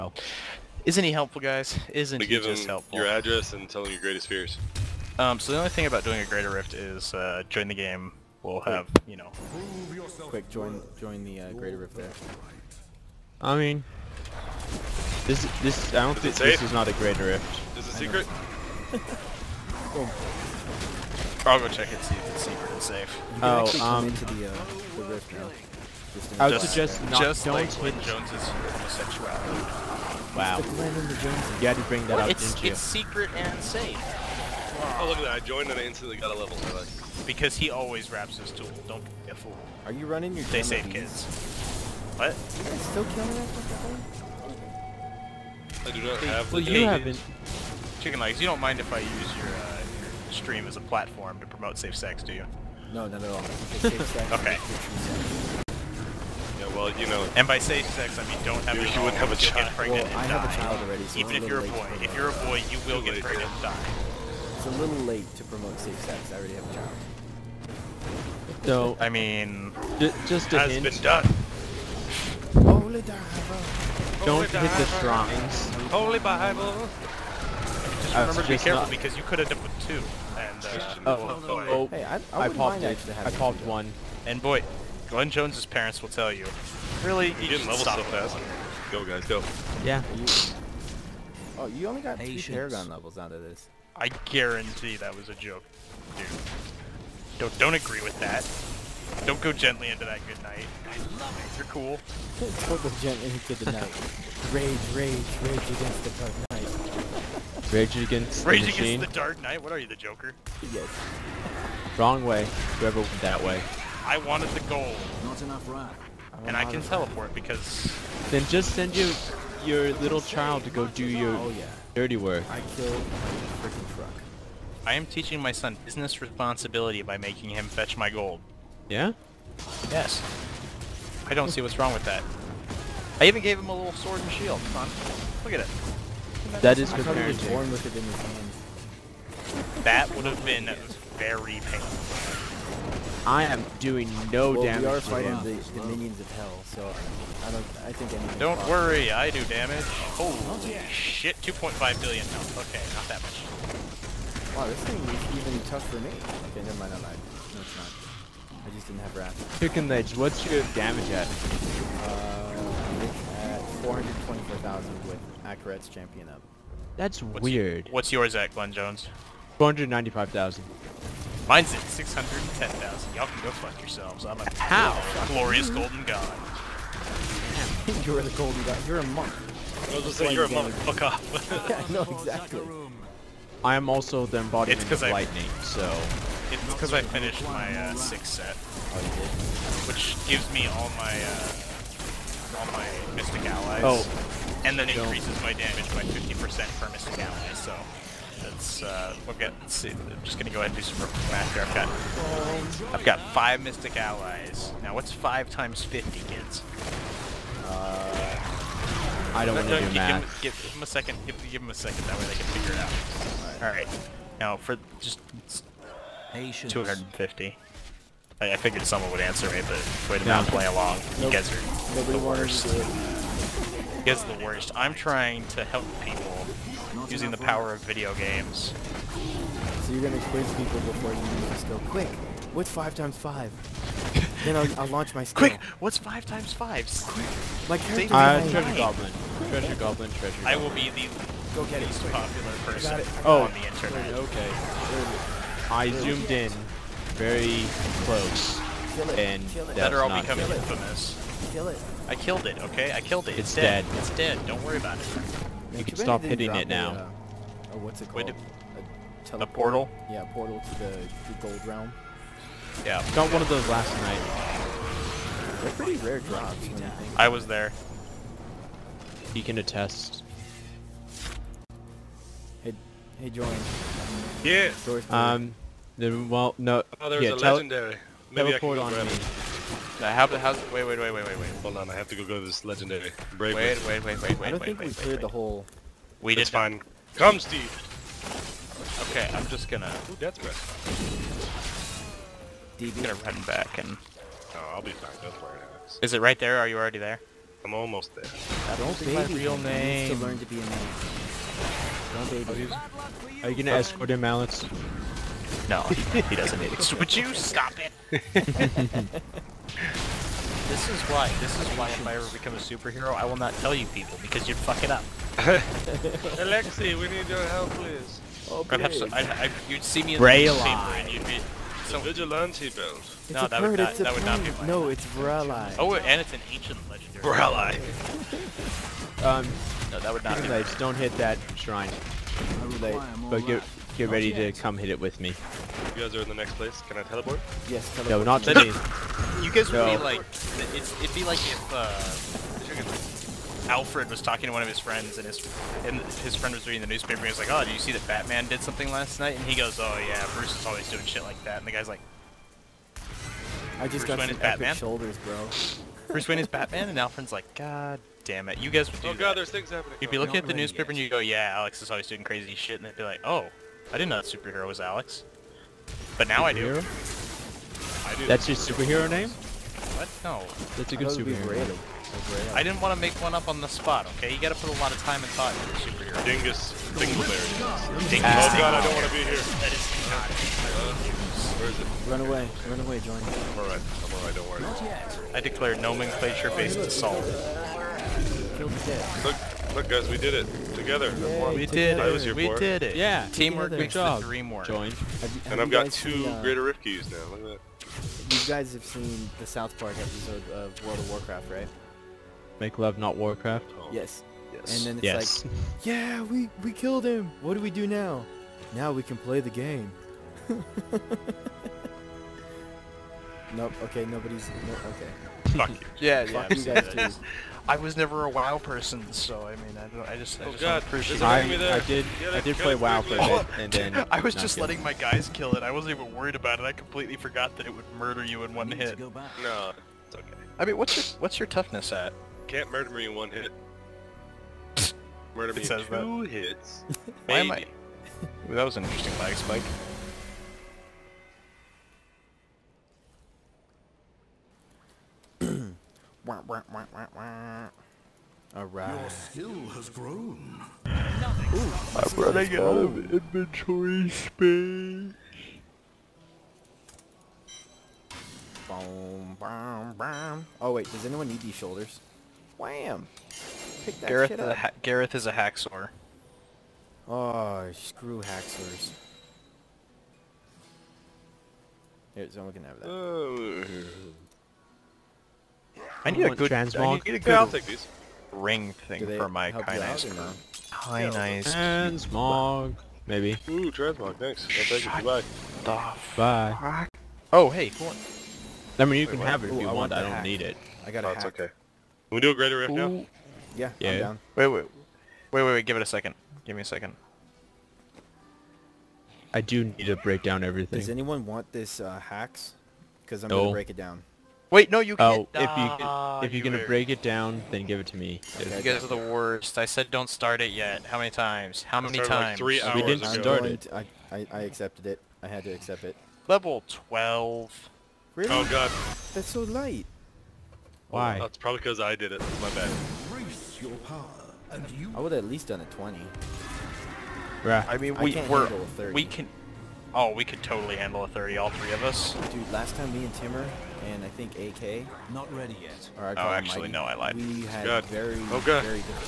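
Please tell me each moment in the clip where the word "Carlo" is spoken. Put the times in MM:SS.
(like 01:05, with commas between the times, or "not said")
not said.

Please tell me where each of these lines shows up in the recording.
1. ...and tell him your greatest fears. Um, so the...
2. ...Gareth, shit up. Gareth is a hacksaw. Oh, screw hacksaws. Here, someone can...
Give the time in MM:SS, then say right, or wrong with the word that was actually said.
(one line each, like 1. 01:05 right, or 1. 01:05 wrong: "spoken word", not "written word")
1. 00:03 right
2. 07:44 right.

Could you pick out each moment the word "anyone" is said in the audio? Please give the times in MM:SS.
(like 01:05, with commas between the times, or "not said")
07:41, 08:20.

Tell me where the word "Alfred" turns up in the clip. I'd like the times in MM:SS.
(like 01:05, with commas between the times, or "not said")
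05:43, 05:56.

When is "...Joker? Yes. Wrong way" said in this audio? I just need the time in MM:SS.
01:49.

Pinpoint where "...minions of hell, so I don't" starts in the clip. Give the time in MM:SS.
02:25.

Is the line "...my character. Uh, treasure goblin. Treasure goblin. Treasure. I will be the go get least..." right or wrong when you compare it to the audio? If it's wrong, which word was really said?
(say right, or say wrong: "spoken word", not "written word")
right.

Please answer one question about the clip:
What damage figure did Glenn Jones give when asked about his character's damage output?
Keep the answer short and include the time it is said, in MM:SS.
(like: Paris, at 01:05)
495,000, at 02:49.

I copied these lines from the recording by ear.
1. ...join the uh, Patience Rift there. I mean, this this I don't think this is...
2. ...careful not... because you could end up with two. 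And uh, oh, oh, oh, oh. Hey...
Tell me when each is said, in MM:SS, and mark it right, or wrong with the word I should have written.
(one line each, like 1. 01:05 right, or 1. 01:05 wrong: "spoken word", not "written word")
1. 00:10 wrong: "Greater", not "Patience"
2. 01:18 right.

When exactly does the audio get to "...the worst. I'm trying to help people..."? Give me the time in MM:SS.
03:44.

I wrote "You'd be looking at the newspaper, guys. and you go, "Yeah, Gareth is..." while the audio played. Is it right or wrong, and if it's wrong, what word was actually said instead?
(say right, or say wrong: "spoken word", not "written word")
wrong: "Alex", not "Gareth".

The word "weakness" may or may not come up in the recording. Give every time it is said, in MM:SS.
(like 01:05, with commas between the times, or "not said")
not said.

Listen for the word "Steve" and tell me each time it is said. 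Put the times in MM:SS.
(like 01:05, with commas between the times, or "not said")
04:47.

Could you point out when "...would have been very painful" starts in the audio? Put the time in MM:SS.
02:20.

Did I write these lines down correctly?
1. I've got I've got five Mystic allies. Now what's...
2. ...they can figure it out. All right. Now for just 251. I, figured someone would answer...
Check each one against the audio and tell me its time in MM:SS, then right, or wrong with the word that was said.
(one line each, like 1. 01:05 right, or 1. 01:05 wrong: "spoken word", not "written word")
1. 03:21 right
2. 03:32 wrong: "250", not "251".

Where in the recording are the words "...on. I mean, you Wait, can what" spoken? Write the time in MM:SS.
08:07.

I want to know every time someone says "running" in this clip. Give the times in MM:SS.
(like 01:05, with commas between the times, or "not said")
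00:40, 07:32.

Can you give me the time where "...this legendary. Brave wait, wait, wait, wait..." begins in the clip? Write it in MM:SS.
04:42.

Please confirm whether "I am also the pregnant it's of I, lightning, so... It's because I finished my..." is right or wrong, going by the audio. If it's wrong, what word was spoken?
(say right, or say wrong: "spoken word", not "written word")
wrong: "embodiment", not "pregnant".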